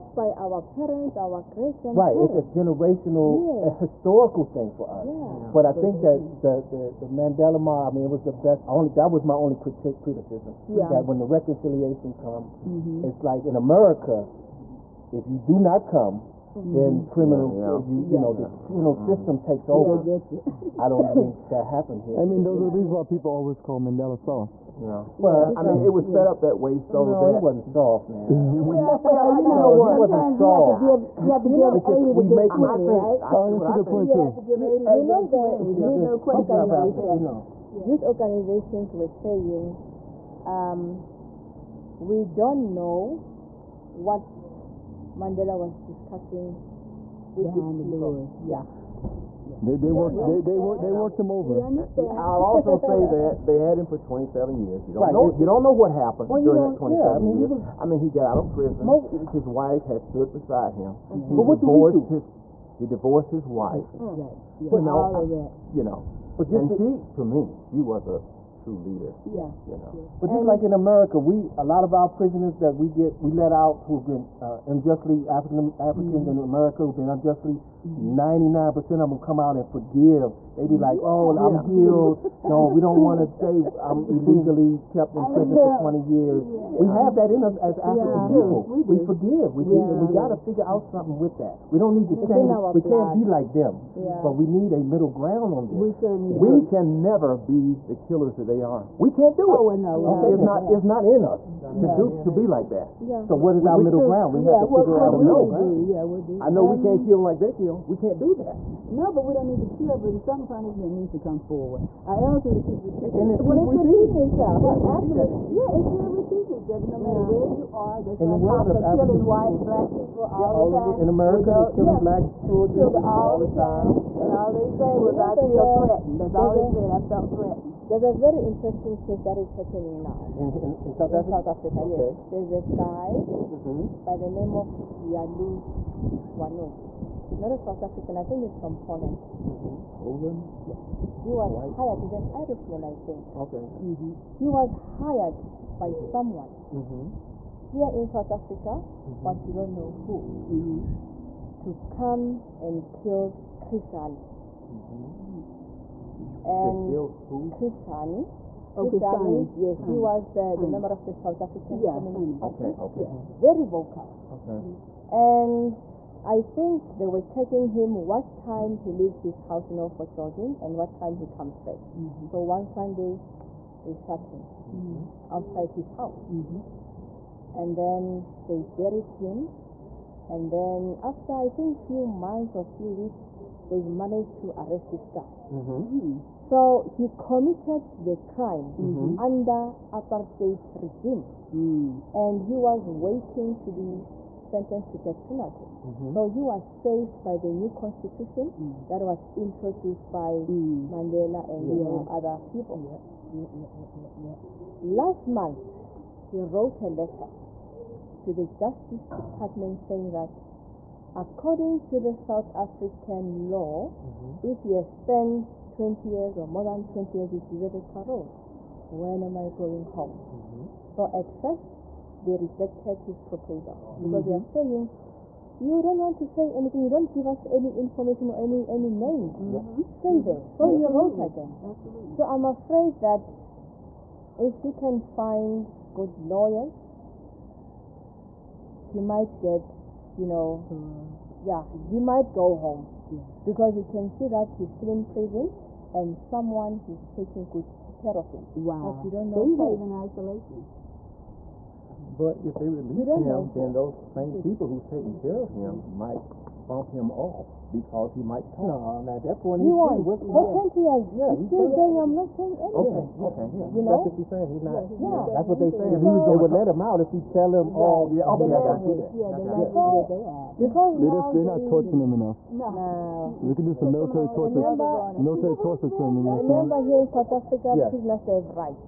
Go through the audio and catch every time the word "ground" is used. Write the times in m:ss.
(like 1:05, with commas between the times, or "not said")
1:35, 1:44.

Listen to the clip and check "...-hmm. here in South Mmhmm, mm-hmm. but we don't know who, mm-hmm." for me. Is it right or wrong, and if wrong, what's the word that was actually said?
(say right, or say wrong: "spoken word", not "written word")
wrong: "Africa", not "Mmhmm".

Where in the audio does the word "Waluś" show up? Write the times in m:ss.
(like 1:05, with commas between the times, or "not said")
2:16.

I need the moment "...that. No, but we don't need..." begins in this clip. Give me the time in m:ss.
1:48.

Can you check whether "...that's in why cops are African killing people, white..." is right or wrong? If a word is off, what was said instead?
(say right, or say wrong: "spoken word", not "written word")
right.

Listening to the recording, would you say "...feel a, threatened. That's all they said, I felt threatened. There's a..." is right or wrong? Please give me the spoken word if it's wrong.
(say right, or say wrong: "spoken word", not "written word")
right.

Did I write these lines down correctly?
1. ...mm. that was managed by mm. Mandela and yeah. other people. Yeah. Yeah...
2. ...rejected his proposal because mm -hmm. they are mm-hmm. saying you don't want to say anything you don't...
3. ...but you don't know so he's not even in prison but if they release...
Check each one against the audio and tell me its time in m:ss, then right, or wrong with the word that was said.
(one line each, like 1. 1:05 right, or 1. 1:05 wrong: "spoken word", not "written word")
1. 3:18 wrong: "introduced", not "managed"
2. 3:42 right
3. 4:08 wrong: "isolation", not "prison".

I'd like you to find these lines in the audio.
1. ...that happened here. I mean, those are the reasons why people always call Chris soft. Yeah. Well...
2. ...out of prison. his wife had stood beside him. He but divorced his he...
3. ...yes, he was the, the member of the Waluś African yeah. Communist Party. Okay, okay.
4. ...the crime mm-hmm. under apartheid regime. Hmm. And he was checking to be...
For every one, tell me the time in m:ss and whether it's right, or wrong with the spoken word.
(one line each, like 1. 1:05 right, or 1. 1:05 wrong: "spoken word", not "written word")
1. 0:21 wrong: "Mandela", not "Chris"
2. 0:58 right
3. 2:39 wrong: "South", not "Waluś"
4. 3:08 wrong: "waiting", not "checking".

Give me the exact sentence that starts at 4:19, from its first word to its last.
No, at that point, he's free.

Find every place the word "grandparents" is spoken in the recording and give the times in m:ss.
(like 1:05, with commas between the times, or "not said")
0:01.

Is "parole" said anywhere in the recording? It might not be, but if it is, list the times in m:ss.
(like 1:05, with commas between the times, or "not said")
3:37.